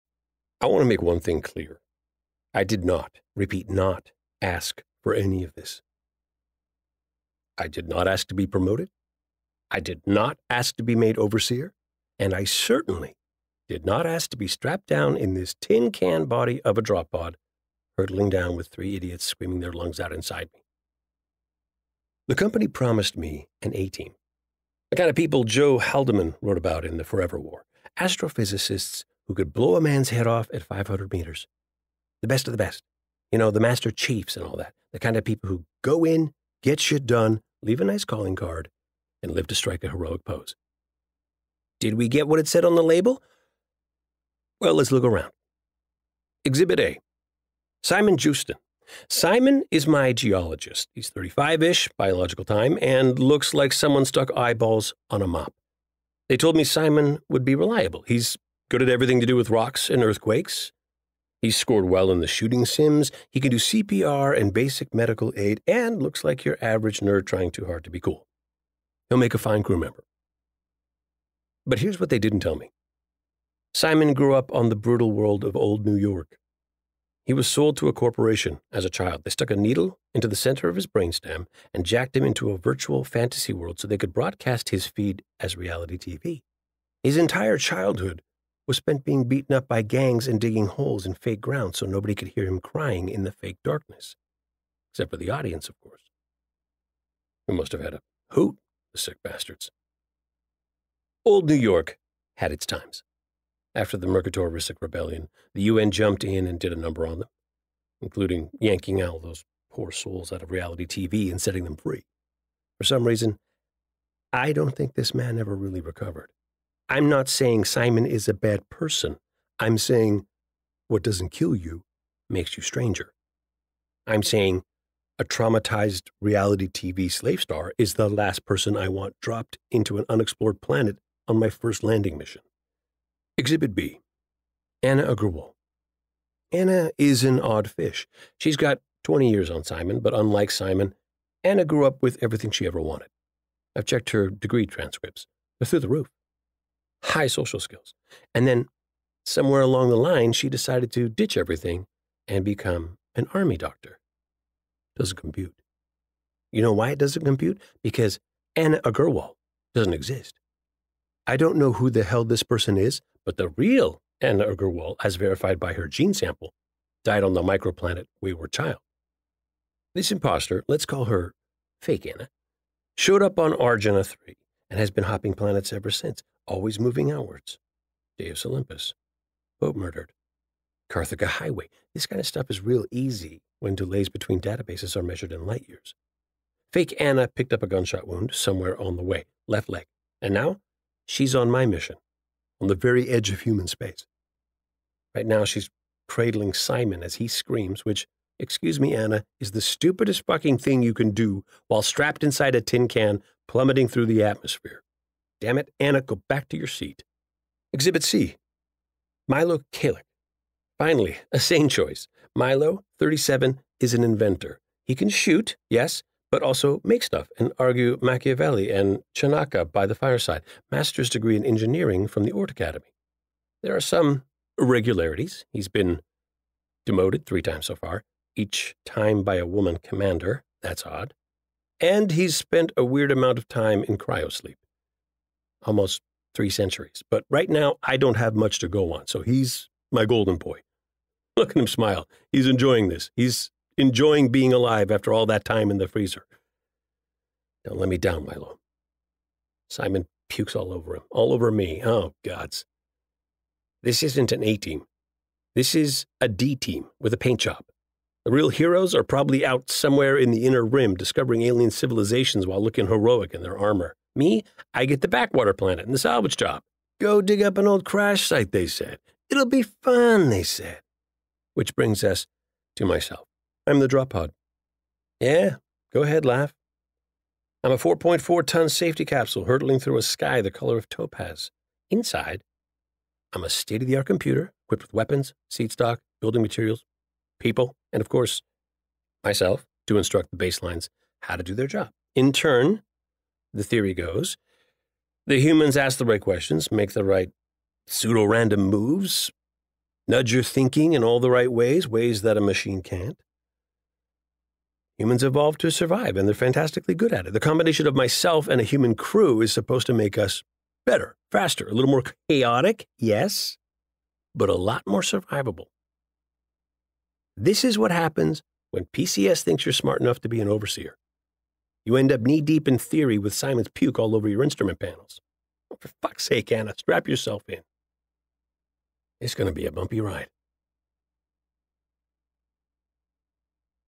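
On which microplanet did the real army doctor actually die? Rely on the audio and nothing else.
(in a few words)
Wayward Child.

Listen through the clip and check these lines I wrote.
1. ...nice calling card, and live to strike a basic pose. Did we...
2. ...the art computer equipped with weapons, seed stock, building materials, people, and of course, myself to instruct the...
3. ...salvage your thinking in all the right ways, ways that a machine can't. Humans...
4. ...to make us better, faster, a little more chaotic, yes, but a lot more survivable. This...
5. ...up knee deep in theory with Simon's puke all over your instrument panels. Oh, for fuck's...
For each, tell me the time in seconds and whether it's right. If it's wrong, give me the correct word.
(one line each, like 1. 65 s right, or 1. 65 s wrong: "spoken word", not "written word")
1. 37 s wrong: "heroic", not "basic"
2. 283 s right
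3. 300 s wrong: "nudge", not "salvage"
4. 309 s right
5. 322 s right.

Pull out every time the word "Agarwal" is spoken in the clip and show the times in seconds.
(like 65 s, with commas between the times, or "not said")
135 s, 158 s, 164 s.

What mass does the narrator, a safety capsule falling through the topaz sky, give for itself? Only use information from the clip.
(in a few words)
4.4 tons.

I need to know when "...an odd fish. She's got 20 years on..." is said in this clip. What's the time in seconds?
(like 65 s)
137 s.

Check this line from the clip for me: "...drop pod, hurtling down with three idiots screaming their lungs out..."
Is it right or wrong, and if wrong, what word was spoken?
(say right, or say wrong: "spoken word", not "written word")
right.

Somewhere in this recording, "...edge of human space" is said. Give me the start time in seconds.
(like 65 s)
193 s.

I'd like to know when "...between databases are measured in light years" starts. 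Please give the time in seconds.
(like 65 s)
184 s.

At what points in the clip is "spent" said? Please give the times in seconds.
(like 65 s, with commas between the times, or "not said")
88 s, 232 s.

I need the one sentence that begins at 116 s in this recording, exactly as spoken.
I'm not saying Simon is a bad person.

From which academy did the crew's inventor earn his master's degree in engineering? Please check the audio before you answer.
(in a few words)
Ort Academy.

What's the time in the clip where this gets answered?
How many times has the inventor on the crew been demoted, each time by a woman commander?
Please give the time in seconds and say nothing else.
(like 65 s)
227 s.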